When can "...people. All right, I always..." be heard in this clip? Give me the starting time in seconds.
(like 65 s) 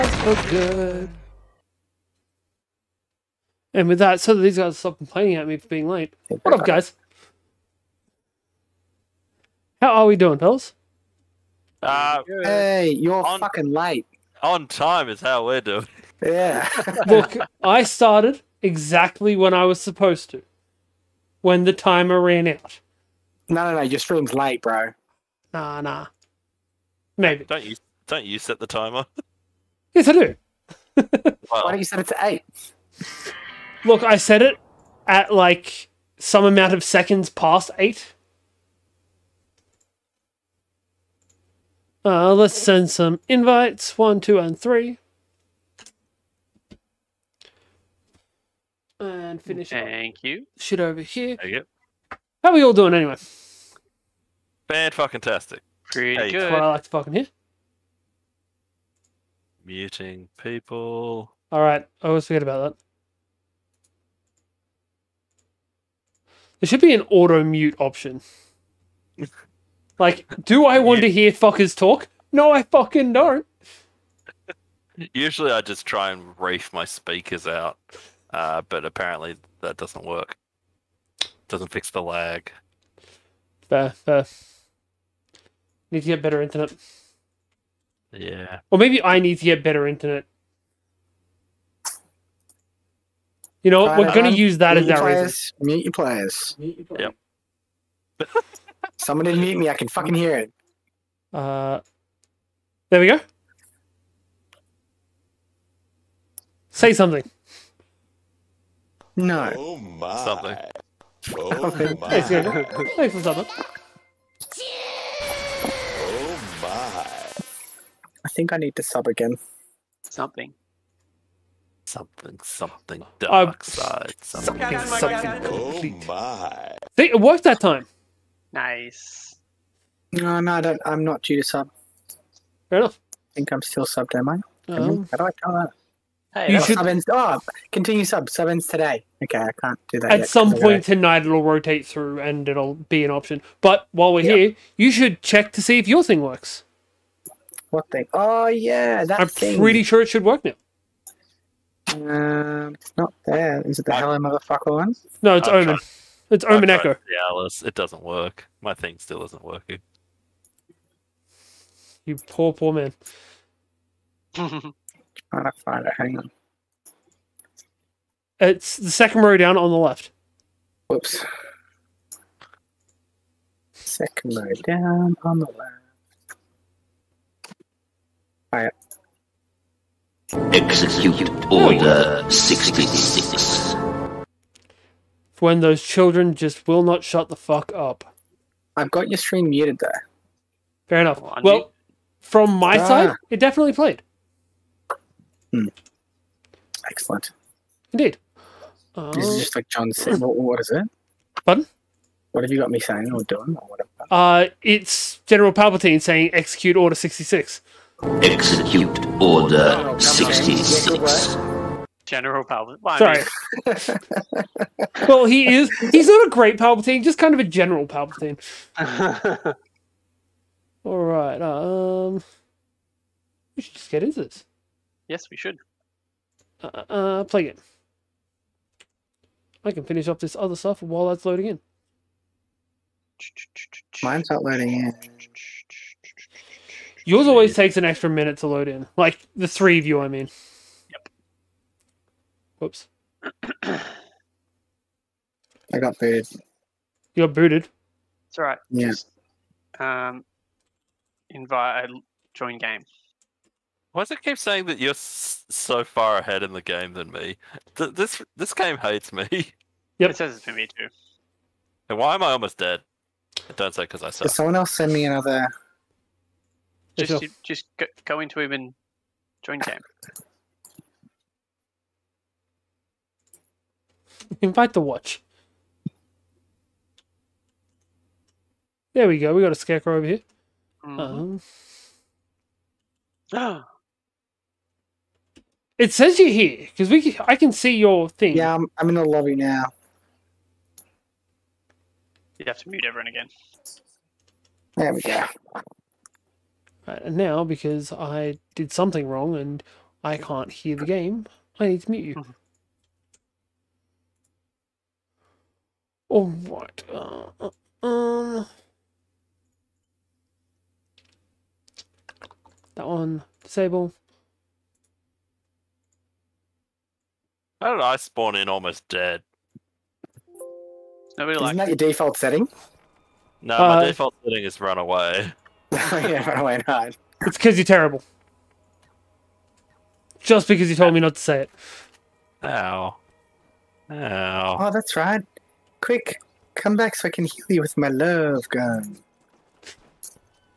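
60 s.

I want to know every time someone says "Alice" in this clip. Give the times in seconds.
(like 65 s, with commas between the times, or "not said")
157 s.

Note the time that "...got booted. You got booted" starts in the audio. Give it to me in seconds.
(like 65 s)
245 s.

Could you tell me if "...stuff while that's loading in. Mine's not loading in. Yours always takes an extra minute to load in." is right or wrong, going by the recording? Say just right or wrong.
right.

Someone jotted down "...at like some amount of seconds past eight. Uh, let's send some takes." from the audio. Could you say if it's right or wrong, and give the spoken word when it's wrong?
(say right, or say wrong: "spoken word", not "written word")
wrong: "invites", not "takes".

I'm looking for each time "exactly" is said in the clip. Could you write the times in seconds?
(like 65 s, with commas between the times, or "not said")
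18 s.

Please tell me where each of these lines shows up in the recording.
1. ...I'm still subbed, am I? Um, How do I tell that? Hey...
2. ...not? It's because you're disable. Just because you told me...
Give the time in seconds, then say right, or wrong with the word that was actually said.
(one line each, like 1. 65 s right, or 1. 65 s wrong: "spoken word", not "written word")
1. 133 s right
2. 326 s wrong: "terrible", not "disable".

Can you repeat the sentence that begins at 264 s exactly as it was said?
Did someone else send me another just, just go into him and join camp.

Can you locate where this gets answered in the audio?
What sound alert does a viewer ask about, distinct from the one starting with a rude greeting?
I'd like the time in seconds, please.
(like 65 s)
156 s.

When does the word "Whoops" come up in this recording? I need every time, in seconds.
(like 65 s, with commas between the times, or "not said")
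170 s, 242 s.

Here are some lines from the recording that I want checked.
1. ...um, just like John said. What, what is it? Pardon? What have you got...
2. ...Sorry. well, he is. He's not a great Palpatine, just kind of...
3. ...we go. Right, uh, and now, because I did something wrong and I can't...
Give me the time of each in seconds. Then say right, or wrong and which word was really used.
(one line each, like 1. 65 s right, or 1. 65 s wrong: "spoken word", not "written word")
1. 199 s right
2. 213 s right
3. 294 s right.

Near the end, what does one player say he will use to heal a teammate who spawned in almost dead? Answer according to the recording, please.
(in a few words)
love gun.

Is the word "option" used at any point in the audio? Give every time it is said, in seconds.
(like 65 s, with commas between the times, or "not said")
67 s, 143 s.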